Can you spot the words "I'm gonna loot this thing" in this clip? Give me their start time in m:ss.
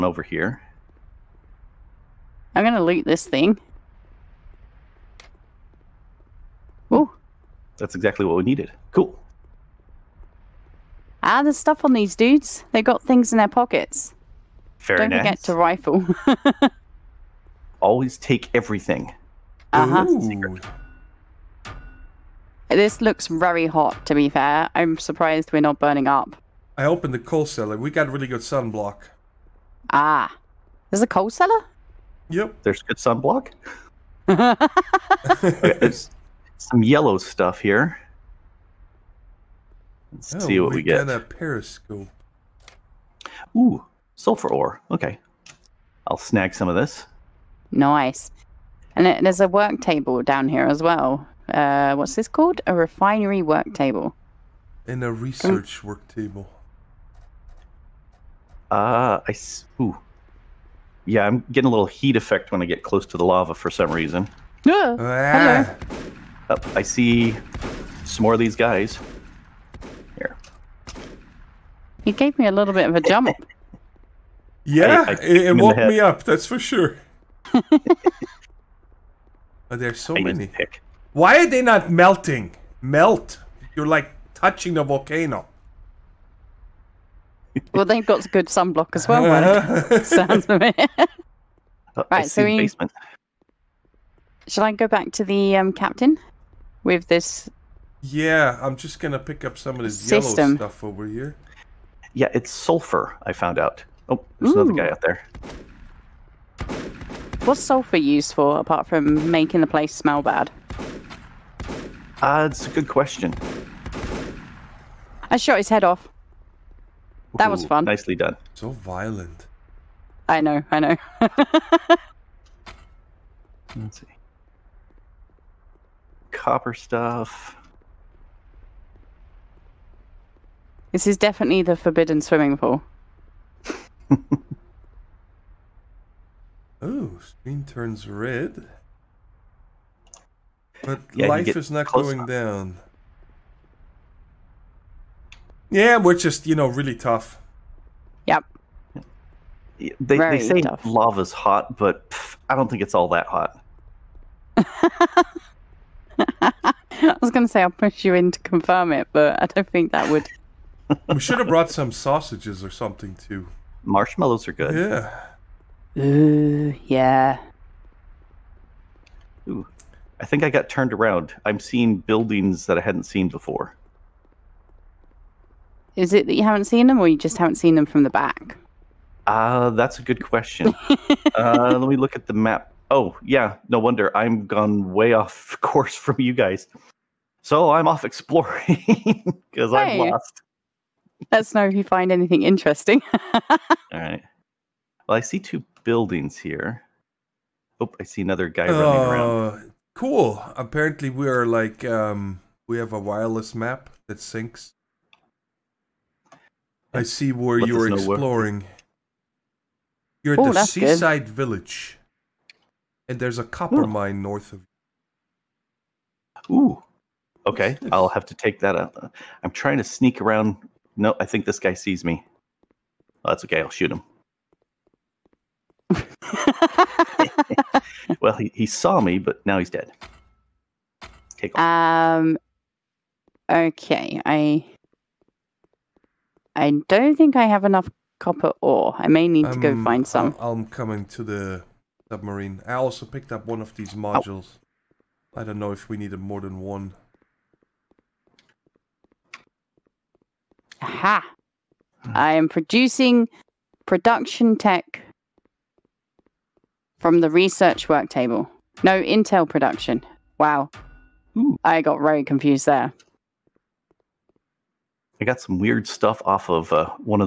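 0:02.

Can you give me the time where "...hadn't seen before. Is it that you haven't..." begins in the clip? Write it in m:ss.
2:52.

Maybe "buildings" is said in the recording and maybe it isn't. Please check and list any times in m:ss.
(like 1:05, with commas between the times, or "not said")
2:51, 3:15.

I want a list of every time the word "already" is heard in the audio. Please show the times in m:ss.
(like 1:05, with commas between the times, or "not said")
not said.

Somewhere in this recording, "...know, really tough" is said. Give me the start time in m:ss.
2:26.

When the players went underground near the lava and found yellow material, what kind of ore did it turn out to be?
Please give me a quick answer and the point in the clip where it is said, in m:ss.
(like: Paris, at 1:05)
Sulfur ore, at 0:44.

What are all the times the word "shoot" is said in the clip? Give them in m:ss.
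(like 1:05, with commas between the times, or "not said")
3:43.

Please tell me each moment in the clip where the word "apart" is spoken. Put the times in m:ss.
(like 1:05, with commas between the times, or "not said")
1:48.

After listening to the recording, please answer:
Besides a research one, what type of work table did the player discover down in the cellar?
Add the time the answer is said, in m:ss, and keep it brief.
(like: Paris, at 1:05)
Refinery work table, at 0:52.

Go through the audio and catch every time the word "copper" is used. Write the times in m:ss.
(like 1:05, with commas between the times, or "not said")
2:06, 3:33, 3:58.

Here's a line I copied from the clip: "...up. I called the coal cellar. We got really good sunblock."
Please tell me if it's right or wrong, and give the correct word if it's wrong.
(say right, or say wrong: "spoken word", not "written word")
wrong: "opened", not "called".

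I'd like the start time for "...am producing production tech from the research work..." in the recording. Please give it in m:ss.
4:12.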